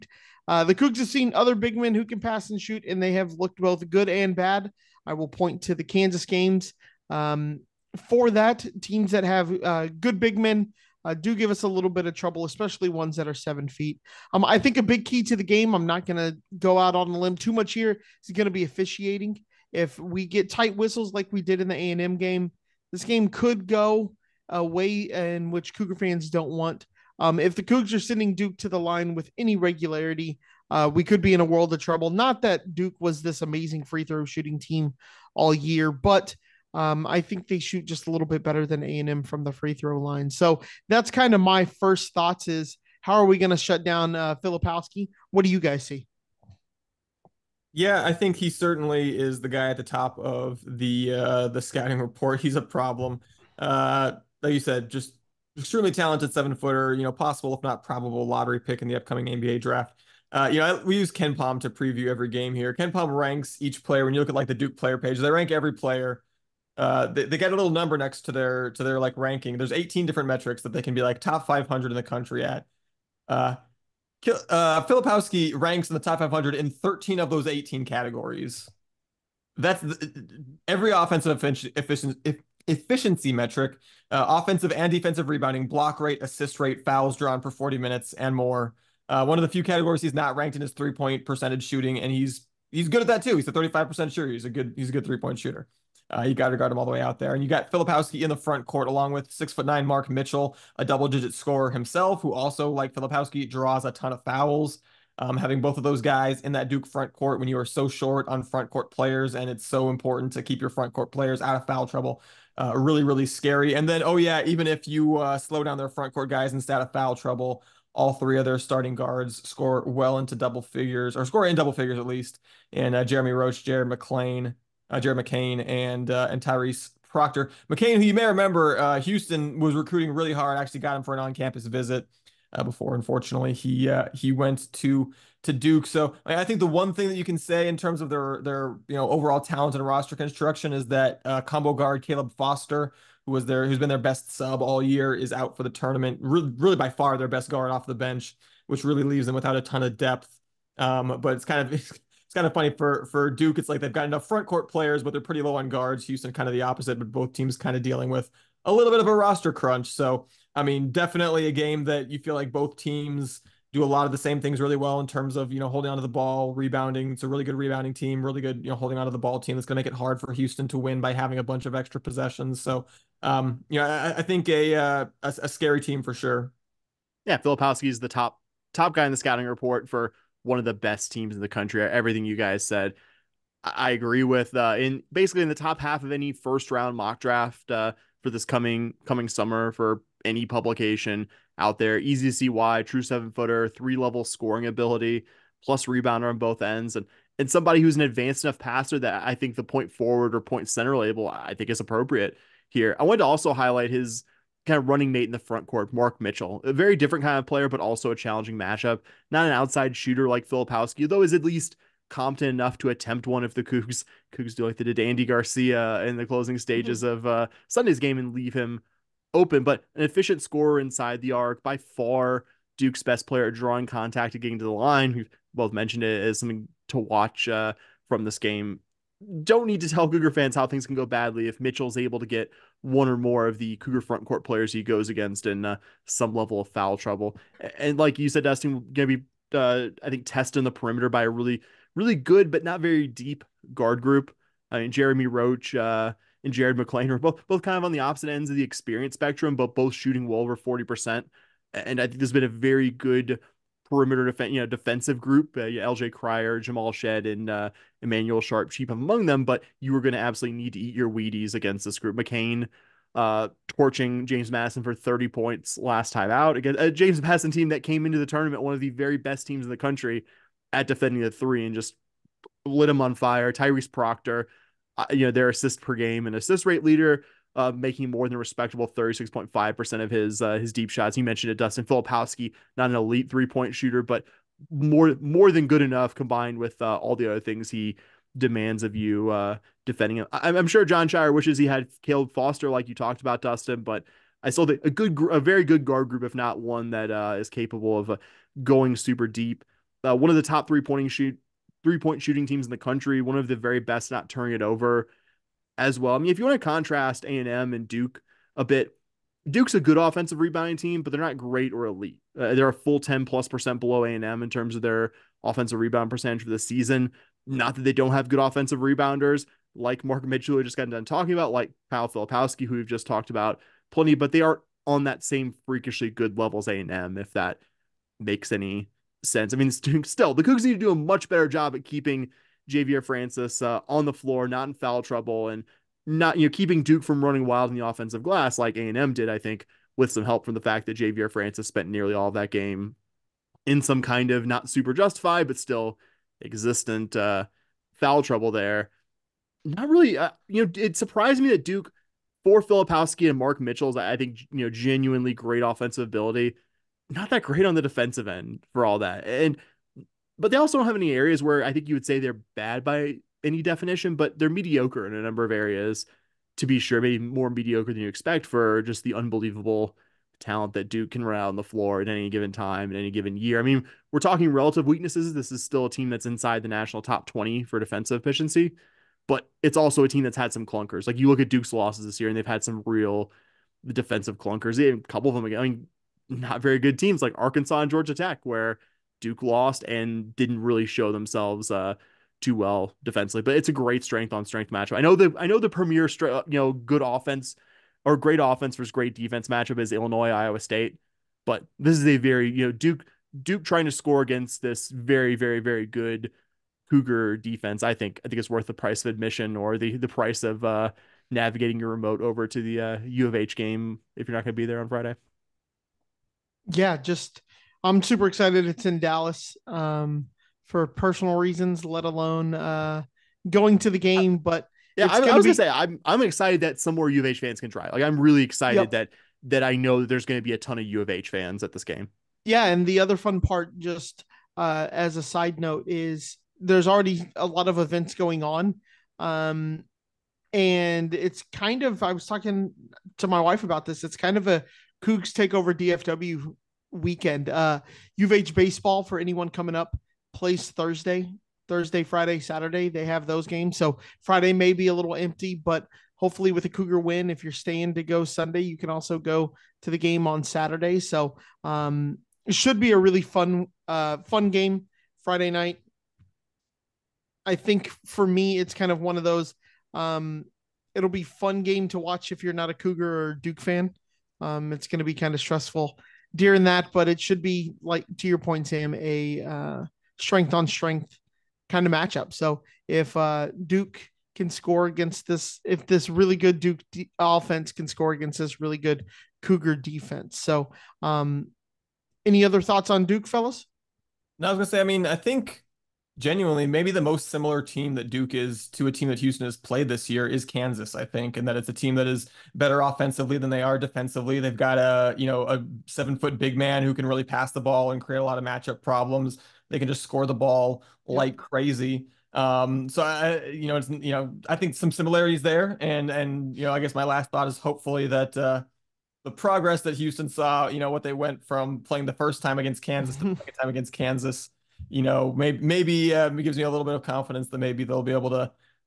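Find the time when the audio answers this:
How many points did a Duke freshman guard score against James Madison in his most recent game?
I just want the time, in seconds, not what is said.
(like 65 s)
264 s.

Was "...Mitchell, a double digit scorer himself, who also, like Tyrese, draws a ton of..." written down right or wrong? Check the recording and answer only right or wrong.
wrong.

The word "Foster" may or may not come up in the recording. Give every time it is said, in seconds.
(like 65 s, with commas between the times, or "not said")
142 s, 292 s.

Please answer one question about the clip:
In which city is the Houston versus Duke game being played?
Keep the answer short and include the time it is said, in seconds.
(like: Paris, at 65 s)
Dallas, at 418 s.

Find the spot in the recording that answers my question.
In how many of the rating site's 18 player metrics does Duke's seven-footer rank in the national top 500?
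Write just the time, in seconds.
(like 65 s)
76 s.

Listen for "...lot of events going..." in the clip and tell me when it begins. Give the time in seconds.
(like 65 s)
437 s.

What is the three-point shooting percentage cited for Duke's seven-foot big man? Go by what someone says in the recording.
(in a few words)
35%.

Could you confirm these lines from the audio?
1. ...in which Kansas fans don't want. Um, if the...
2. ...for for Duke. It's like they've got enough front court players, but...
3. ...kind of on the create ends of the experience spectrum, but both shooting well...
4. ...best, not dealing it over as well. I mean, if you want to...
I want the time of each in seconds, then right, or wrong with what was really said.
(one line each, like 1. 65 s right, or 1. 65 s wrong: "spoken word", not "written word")
1. 25 s wrong: "Cougar", not "Kansas"
2. 152 s right
3. 247 s wrong: "opposite", not "create"
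4. 303 s wrong: "turning", not "dealing".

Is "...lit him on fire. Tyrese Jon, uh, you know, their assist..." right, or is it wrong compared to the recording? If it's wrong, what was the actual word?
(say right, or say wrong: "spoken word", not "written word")
wrong: "Proctor", not "Jon".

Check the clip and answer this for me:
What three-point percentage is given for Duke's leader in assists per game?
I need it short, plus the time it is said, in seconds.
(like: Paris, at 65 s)
36.5%, at 278 s.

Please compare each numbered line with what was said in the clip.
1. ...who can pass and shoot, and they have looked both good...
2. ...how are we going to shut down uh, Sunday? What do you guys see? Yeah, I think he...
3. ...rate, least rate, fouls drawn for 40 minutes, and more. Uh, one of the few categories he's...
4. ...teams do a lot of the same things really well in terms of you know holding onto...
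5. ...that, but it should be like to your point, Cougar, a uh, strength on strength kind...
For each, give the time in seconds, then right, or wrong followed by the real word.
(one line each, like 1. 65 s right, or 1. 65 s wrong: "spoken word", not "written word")
1. 1 s right
2. 43 s wrong: "Filipowski", not "Sunday"
3. 85 s wrong: "assist", not "least"
4. 162 s right
5. 476 s wrong: "Sam", not "Cougar".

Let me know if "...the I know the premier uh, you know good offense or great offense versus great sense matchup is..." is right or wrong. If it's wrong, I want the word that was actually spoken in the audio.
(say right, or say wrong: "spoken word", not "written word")
wrong: "defense", not "sense".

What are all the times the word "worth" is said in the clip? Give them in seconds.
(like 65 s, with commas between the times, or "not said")
408 s.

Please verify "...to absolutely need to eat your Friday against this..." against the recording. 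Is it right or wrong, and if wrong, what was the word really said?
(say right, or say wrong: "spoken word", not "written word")
wrong: "Wheaties", not "Friday".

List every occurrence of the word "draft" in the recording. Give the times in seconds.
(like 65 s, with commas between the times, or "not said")
59 s, 187 s.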